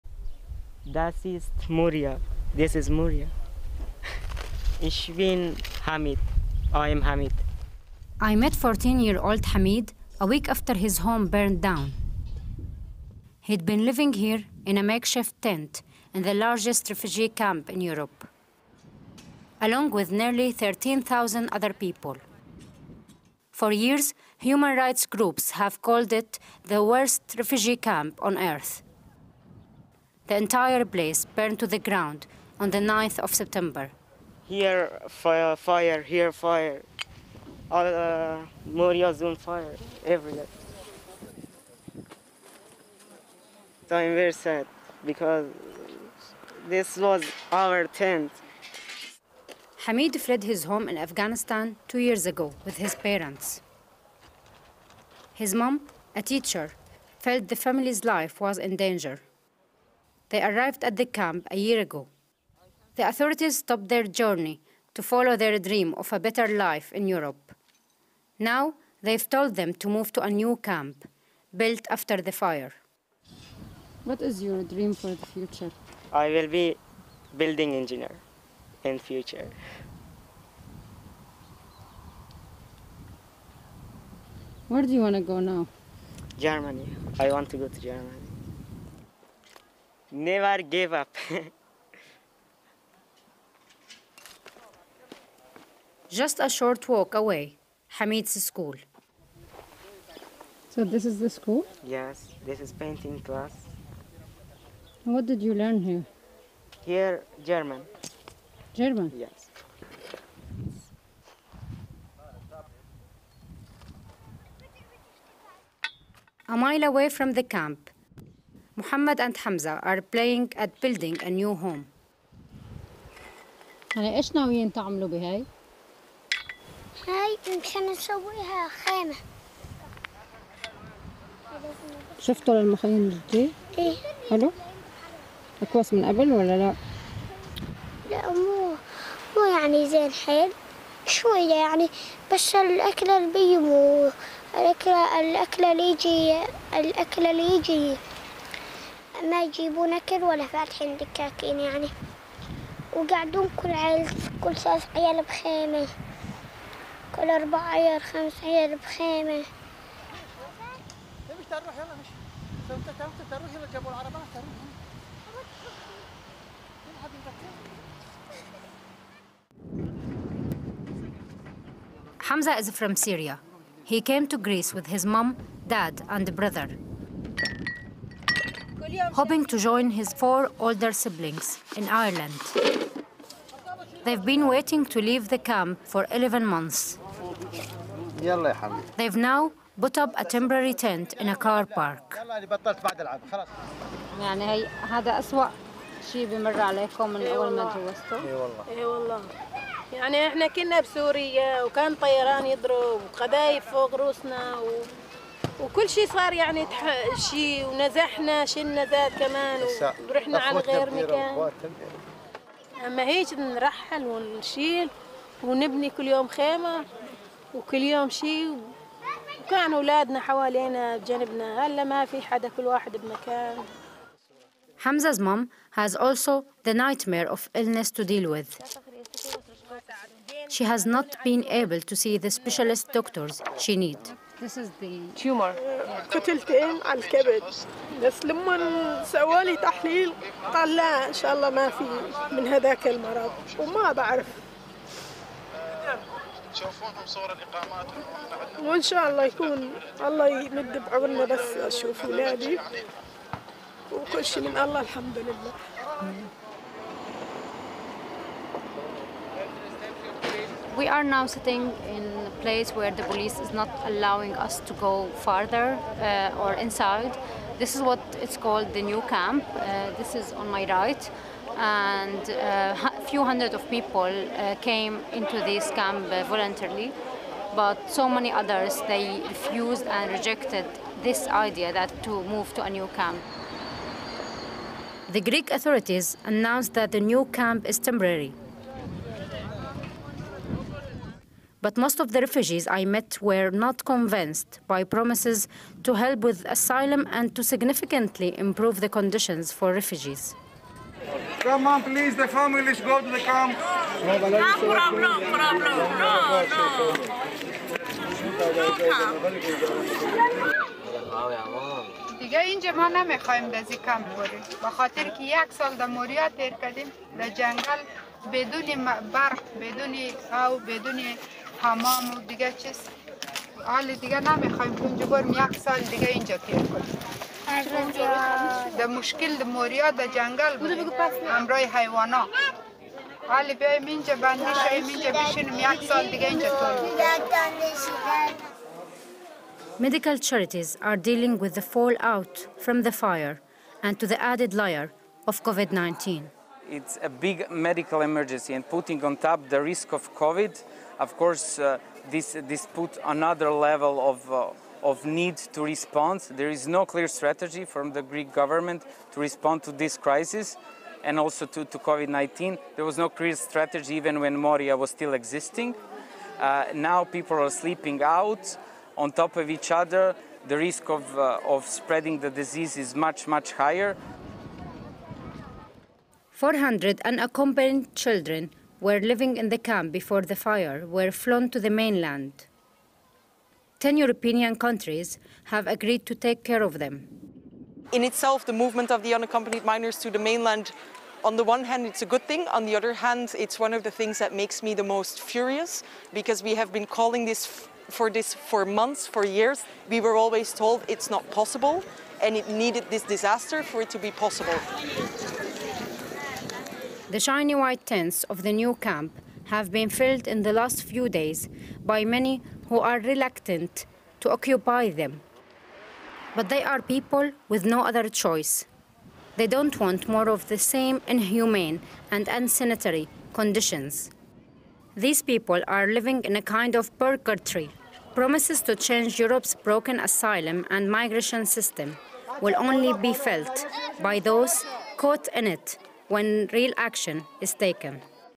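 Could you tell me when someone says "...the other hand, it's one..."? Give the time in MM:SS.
06:32.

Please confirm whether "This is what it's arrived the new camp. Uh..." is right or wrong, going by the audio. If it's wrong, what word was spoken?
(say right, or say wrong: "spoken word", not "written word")
wrong: "called", not "arrived".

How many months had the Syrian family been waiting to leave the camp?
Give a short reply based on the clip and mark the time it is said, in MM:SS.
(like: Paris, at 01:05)
11, at 03:06.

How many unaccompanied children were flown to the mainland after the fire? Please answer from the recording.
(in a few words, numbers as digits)
400.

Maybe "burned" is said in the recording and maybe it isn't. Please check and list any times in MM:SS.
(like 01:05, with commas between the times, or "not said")
00:11, 00:31.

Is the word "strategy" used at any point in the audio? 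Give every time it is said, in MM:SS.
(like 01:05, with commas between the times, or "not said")
05:57, 06:03.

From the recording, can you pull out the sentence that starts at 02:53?
He came to Greece with his mom, dad, and brother.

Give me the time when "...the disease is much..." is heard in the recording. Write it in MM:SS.
06:12.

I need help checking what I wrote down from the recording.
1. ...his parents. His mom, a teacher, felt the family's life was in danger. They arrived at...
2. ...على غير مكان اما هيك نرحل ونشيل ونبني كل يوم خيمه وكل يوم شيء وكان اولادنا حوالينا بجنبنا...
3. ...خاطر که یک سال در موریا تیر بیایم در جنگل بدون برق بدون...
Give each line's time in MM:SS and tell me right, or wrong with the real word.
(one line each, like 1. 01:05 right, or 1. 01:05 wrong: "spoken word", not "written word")
1. 00:52 right
2. 03:30 right
3. 05:14 wrong: "کردیم", not "بیایم".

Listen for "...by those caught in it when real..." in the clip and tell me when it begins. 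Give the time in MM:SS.
07:14.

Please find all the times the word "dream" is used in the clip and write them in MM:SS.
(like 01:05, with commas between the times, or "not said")
01:05, 01:14.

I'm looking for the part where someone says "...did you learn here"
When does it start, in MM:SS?
01:45.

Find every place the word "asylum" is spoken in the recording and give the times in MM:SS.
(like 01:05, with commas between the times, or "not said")
04:56, 07:09.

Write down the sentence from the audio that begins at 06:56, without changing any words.
But they are people with no other choice.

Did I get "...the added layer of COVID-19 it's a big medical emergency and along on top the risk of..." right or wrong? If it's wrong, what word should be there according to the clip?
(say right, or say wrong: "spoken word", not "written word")
wrong: "putting", not "along".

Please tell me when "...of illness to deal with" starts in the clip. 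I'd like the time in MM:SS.
03:47.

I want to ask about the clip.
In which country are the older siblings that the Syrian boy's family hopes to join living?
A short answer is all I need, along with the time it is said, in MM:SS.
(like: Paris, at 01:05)
Ireland, at 03:01.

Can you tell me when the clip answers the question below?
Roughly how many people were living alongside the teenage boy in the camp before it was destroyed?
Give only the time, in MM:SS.
00:20.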